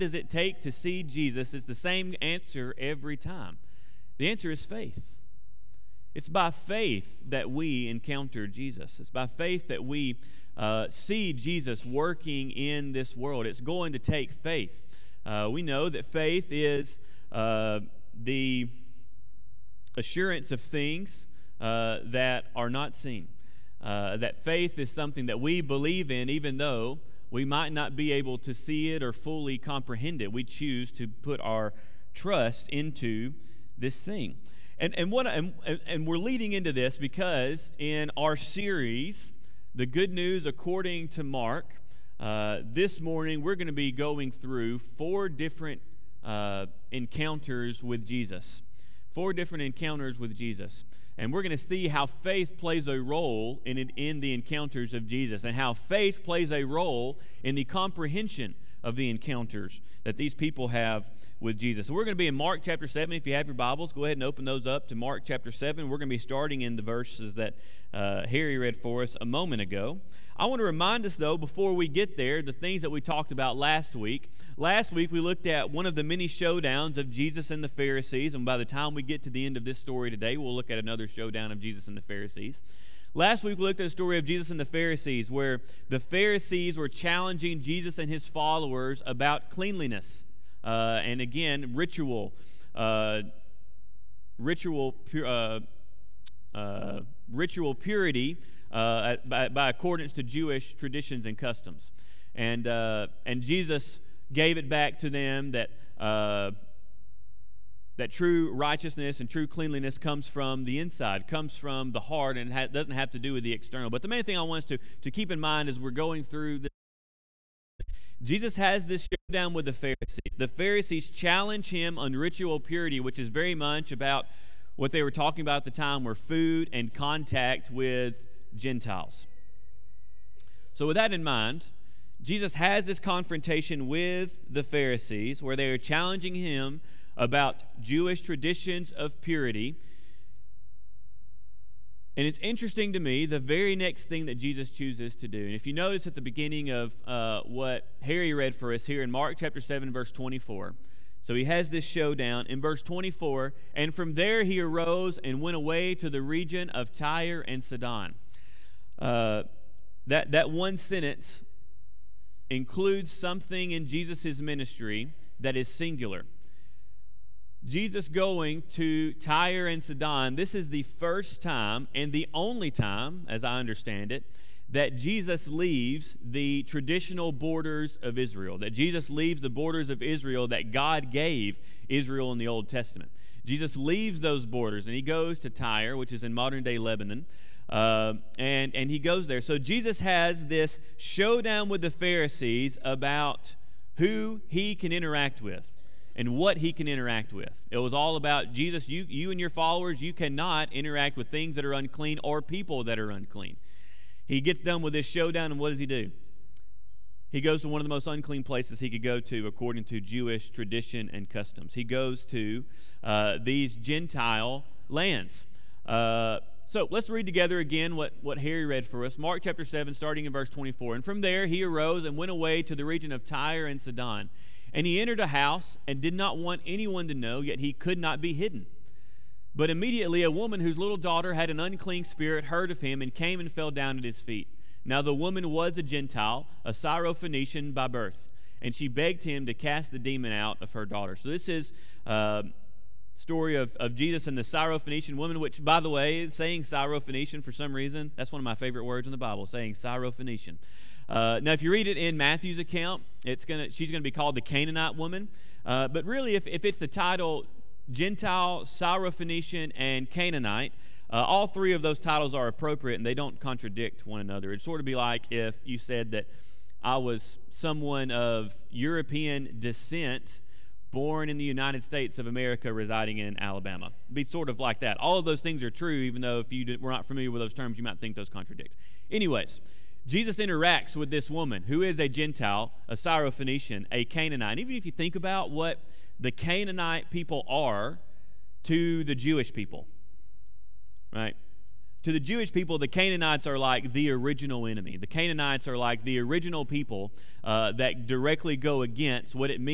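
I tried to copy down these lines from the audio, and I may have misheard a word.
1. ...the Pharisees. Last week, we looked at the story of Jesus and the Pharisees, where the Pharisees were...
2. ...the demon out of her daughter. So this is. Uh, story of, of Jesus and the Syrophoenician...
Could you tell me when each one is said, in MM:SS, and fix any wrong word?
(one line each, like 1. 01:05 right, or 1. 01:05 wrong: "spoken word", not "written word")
1. 01:21 right
2. 03:59 right.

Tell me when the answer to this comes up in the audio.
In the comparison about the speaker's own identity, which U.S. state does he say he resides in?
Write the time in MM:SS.
04:33.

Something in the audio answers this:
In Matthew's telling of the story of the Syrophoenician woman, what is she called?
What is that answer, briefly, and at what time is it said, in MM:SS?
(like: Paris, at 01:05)
The Canaanite woman, at 04:14.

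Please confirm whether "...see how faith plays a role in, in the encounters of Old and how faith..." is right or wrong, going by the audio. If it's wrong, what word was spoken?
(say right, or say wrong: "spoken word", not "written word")
wrong: "Jesus", not "Old".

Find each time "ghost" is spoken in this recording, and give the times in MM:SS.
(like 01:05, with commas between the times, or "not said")
not said.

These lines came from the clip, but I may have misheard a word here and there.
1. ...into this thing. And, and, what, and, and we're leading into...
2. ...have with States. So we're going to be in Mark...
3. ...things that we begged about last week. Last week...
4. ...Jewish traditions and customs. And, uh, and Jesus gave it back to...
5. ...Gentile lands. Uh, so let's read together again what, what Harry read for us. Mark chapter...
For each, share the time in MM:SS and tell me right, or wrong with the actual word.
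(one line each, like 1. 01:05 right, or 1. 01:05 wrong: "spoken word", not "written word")
1. 00:32 right
2. 01:00 wrong: "Jesus", not "States"
3. 01:12 wrong: "talked", not "begged"
4. 01:40 right
5. 03:33 right.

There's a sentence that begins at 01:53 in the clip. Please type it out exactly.
But the main thing I want us to, to keep in mind as we're going through this.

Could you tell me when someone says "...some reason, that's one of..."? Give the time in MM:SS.
04:07.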